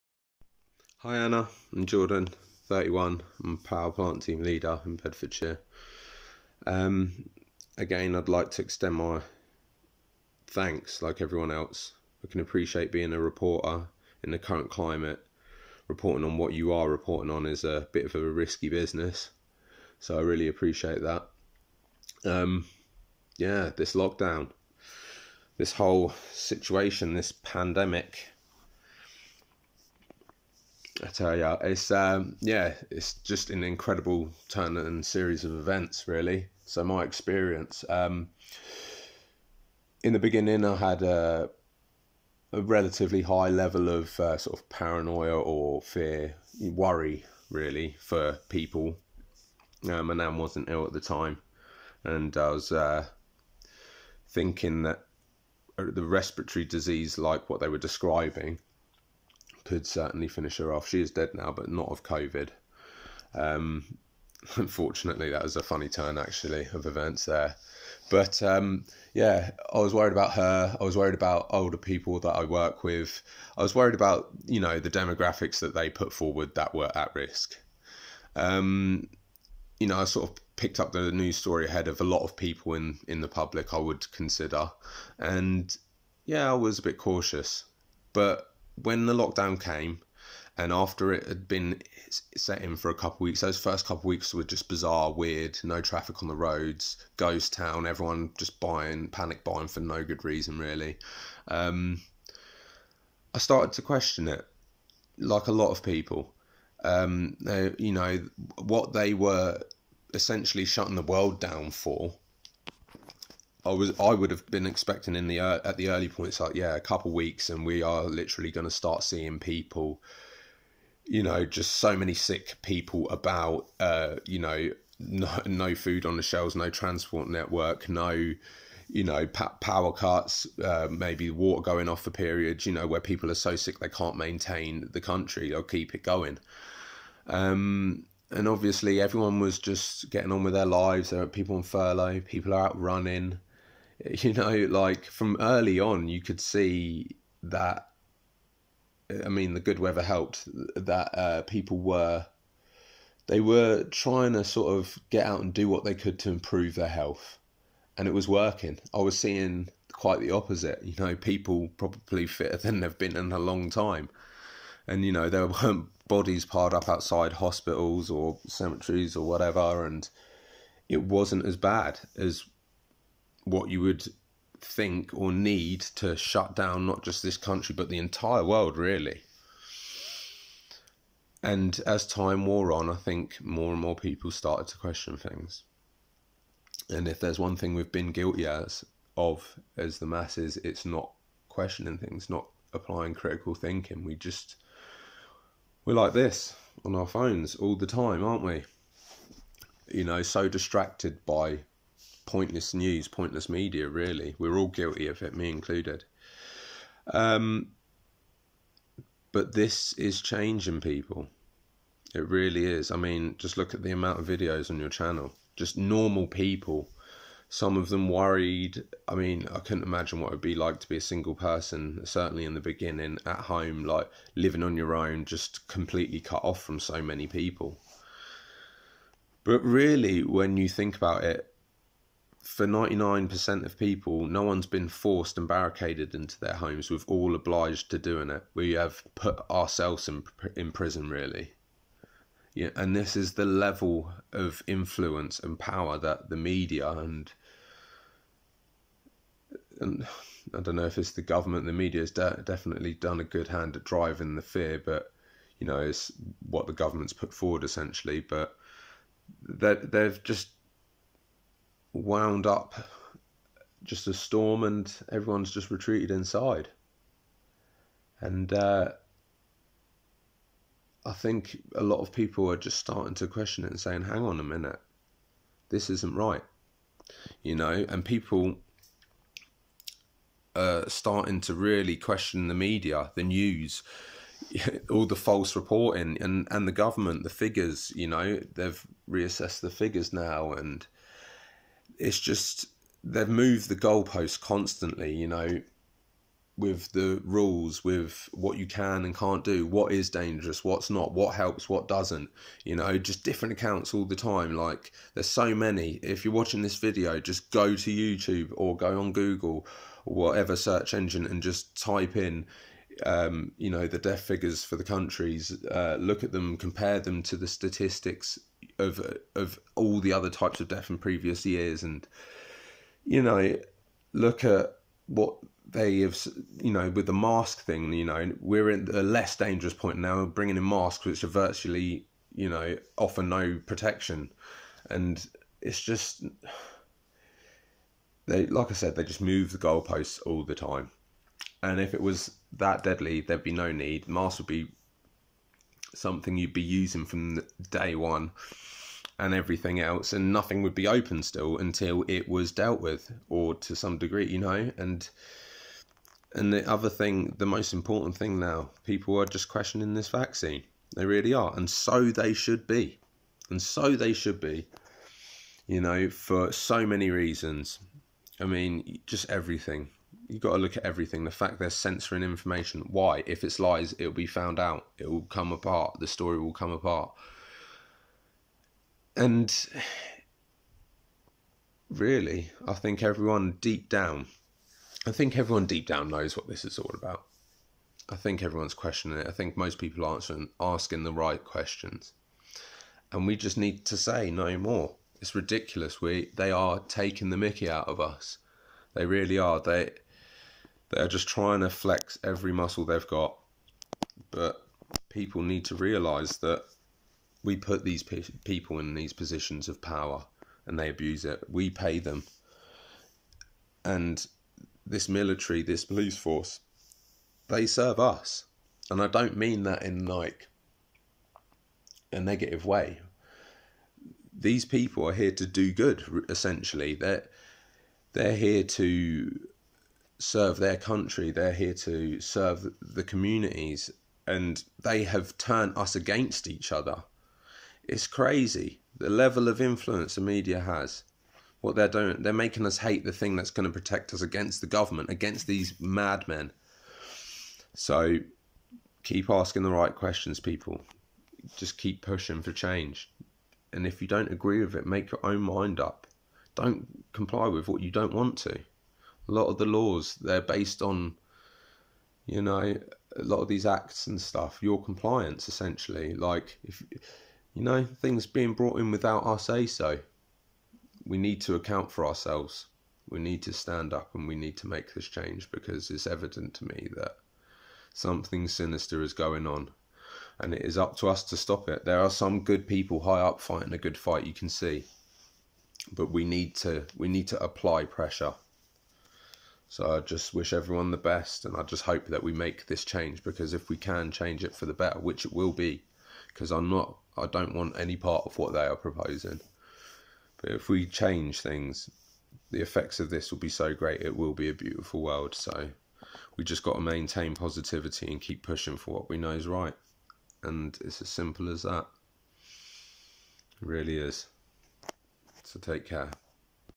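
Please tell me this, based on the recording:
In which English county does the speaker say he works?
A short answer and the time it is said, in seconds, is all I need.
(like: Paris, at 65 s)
Bedfordshire, at 4 s.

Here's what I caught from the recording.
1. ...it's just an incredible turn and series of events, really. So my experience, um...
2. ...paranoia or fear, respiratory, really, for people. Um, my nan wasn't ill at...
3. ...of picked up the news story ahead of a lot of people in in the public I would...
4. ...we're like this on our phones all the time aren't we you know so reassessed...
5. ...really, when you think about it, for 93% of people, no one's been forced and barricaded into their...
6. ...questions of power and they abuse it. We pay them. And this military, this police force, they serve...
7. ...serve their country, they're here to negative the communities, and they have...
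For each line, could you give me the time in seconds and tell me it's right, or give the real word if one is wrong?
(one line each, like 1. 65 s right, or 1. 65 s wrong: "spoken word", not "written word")
1. 32 s right
2. 44 s wrong: "worry", not "respiratory"
3. 80 s right
4. 195 s wrong: "distracted", not "reassessed"
5. 229 s wrong: "99", not "93"
6. 409 s wrong: "positions", not "questions"
7. 430 s wrong: "serve", not "negative".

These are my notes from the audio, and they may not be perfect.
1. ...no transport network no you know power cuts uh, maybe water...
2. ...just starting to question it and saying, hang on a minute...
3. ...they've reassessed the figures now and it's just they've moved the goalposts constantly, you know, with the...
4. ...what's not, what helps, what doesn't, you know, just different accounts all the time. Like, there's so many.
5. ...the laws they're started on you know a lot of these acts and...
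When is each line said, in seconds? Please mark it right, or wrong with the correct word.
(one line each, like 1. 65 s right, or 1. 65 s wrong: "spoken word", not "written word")
1. 126 s right
2. 272 s right
3. 288 s right
4. 300 s right
5. 459 s wrong: "based", not "started".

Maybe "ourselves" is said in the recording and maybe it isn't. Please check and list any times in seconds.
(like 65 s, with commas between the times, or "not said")
239 s, 472 s.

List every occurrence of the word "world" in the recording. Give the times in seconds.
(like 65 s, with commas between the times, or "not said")
111 s, 178 s, 505 s.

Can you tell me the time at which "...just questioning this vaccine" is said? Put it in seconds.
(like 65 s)
359 s.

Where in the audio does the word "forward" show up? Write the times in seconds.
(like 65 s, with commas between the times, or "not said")
76 s, 257 s.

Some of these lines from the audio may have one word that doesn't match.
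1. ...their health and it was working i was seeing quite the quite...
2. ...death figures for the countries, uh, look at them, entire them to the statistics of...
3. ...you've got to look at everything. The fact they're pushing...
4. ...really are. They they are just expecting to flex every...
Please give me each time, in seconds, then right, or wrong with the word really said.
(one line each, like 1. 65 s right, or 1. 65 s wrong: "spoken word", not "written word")
1. 156 s wrong: "opposite", not "quite"
2. 313 s wrong: "compare", not "entire"
3. 370 s wrong: "censoring", not "pushing"
4. 399 s wrong: "trying", not "expecting".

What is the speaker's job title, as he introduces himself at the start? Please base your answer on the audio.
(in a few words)
Power plant team leader.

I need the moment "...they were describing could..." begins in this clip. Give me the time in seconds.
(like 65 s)
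57 s.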